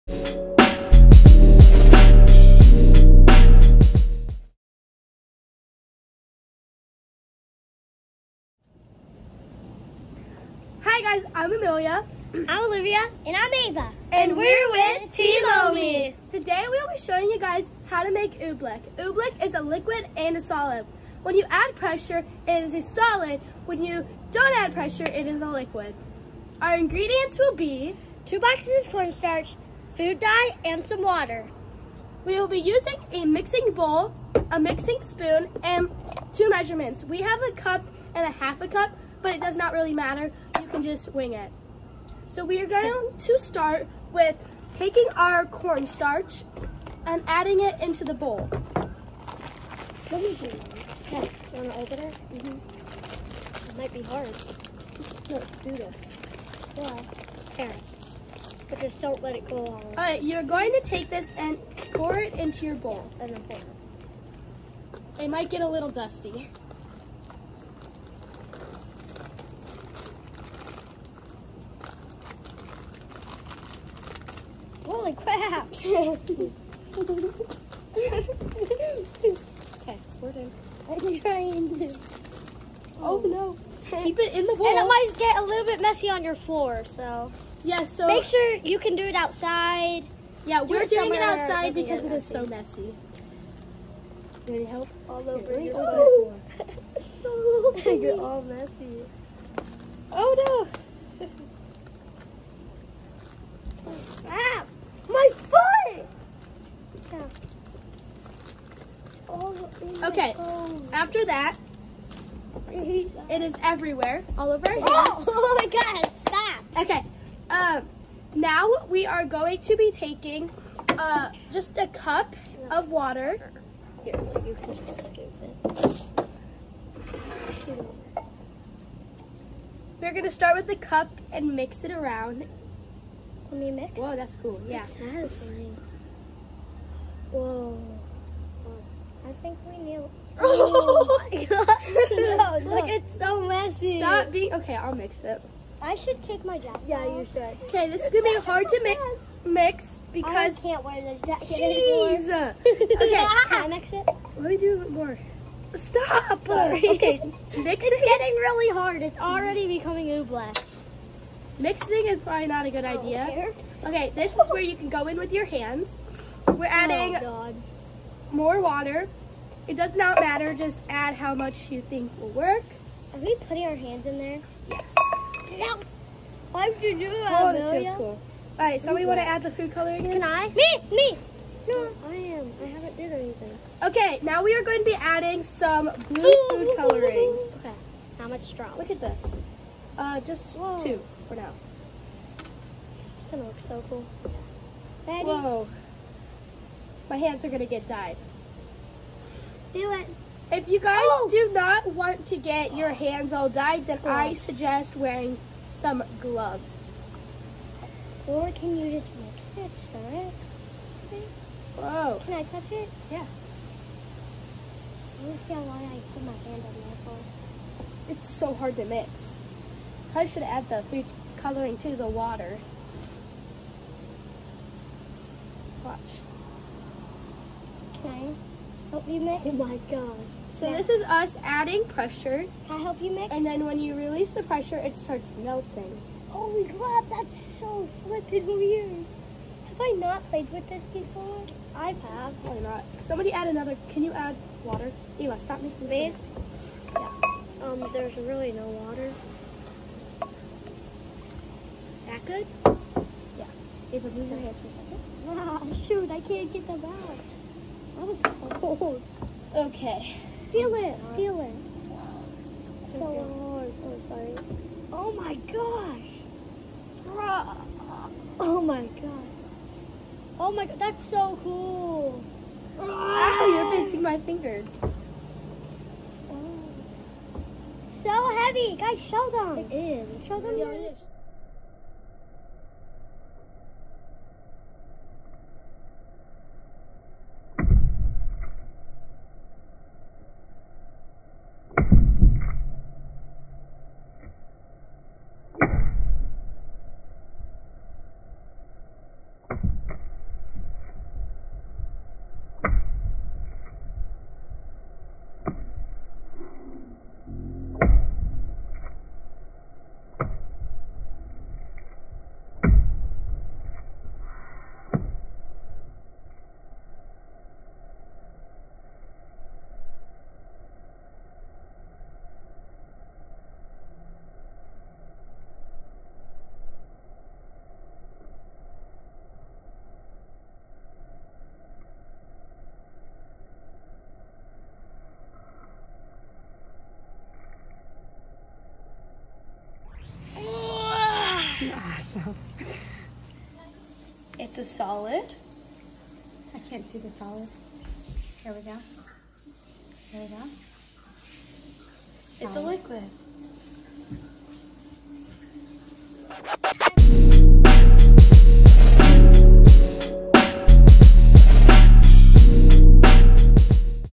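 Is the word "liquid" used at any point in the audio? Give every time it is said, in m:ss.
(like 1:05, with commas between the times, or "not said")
0:19, 0:25, 5:52.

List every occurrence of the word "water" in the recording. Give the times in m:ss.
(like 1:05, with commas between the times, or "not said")
0:31, 2:02, 2:48, 3:42, 4:04, 4:08.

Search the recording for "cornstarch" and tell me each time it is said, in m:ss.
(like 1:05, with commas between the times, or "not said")
0:28, 0:45.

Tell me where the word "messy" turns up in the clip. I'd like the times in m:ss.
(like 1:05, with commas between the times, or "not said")
1:25, 1:32, 1:38.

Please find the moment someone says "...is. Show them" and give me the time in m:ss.
4:39.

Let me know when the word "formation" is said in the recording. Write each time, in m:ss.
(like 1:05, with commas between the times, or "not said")
not said.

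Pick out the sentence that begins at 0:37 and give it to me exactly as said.
We have a cup and a half a cup, but it does not really matter can just wing it.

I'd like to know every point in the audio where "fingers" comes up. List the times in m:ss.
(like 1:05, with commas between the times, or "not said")
4:34.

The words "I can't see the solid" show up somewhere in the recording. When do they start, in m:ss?
5:46.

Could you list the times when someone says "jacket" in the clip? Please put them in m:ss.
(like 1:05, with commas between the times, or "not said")
2:26, 2:31.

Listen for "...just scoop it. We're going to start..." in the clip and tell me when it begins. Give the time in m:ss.
2:04.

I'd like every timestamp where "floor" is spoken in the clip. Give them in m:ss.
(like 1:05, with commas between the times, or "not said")
1:26, 1:35.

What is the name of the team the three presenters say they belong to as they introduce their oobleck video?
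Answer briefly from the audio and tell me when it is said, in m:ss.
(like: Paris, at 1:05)
Team OMie, at 0:15.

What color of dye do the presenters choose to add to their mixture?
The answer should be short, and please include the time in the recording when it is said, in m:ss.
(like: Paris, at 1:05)
blue, at 3:06.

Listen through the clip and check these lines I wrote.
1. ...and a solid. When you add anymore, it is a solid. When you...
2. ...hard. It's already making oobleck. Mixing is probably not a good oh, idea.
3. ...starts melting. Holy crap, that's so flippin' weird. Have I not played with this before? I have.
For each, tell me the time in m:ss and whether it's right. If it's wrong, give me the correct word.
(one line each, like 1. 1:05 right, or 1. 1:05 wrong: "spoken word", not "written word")
1. 0:20 wrong: "pressure", not "anymore"
2. 2:38 wrong: "becoming", not "making"
3. 3:54 right.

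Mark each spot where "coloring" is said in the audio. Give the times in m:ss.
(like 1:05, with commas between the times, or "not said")
2:59, 3:06, 3:41.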